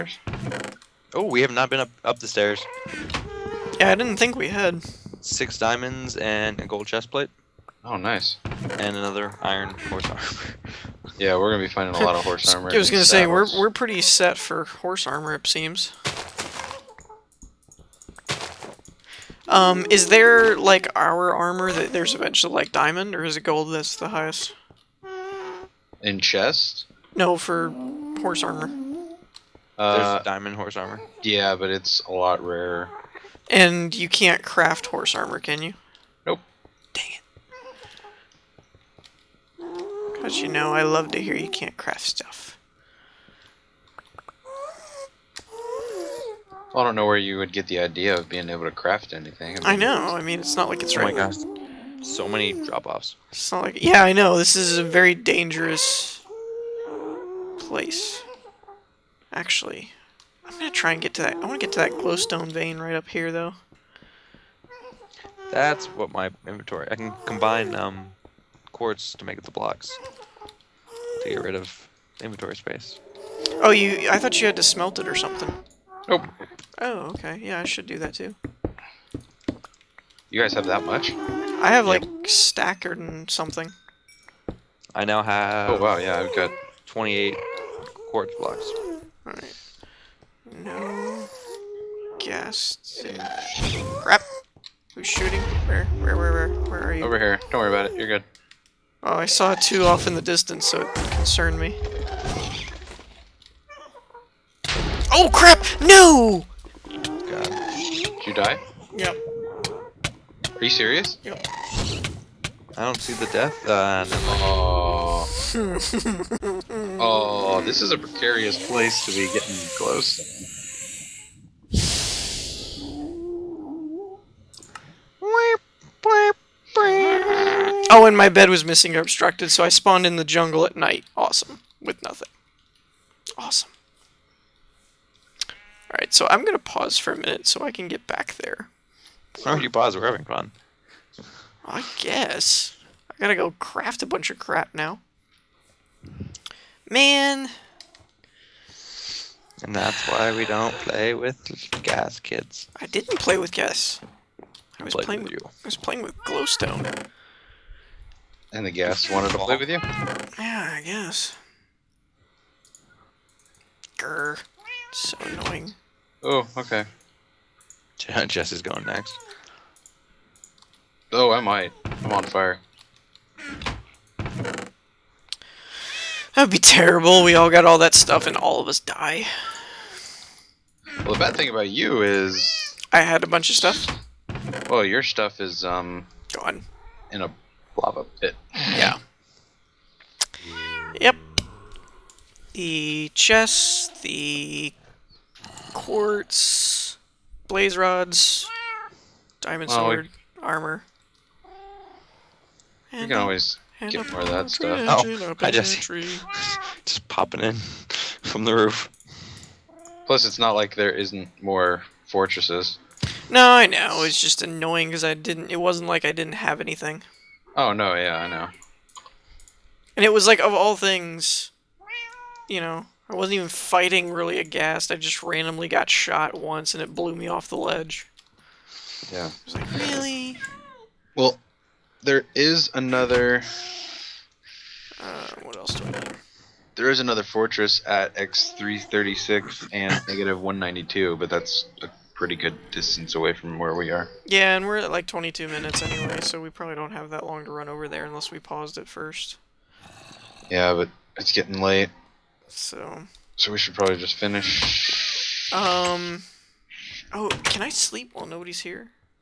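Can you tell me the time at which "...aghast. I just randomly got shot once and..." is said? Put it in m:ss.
3:44.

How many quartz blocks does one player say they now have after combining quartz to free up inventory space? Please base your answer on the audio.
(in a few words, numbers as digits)
28.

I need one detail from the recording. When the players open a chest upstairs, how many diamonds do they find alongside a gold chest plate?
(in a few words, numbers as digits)
6.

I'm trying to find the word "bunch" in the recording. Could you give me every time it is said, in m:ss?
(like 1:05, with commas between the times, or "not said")
2:24, 3:03.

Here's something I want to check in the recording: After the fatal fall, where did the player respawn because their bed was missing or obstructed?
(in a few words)
the jungle.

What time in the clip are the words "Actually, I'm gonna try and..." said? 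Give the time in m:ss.
0:59.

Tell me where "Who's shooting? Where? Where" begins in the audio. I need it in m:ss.
1:34.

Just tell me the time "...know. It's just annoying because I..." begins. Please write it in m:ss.
3:33.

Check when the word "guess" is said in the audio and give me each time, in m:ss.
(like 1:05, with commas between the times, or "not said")
2:21, 2:40.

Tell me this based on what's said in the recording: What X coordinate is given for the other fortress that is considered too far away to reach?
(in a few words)
336.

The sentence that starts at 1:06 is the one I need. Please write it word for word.
I can combine um, quartz to make the blocks to get rid of inventory space.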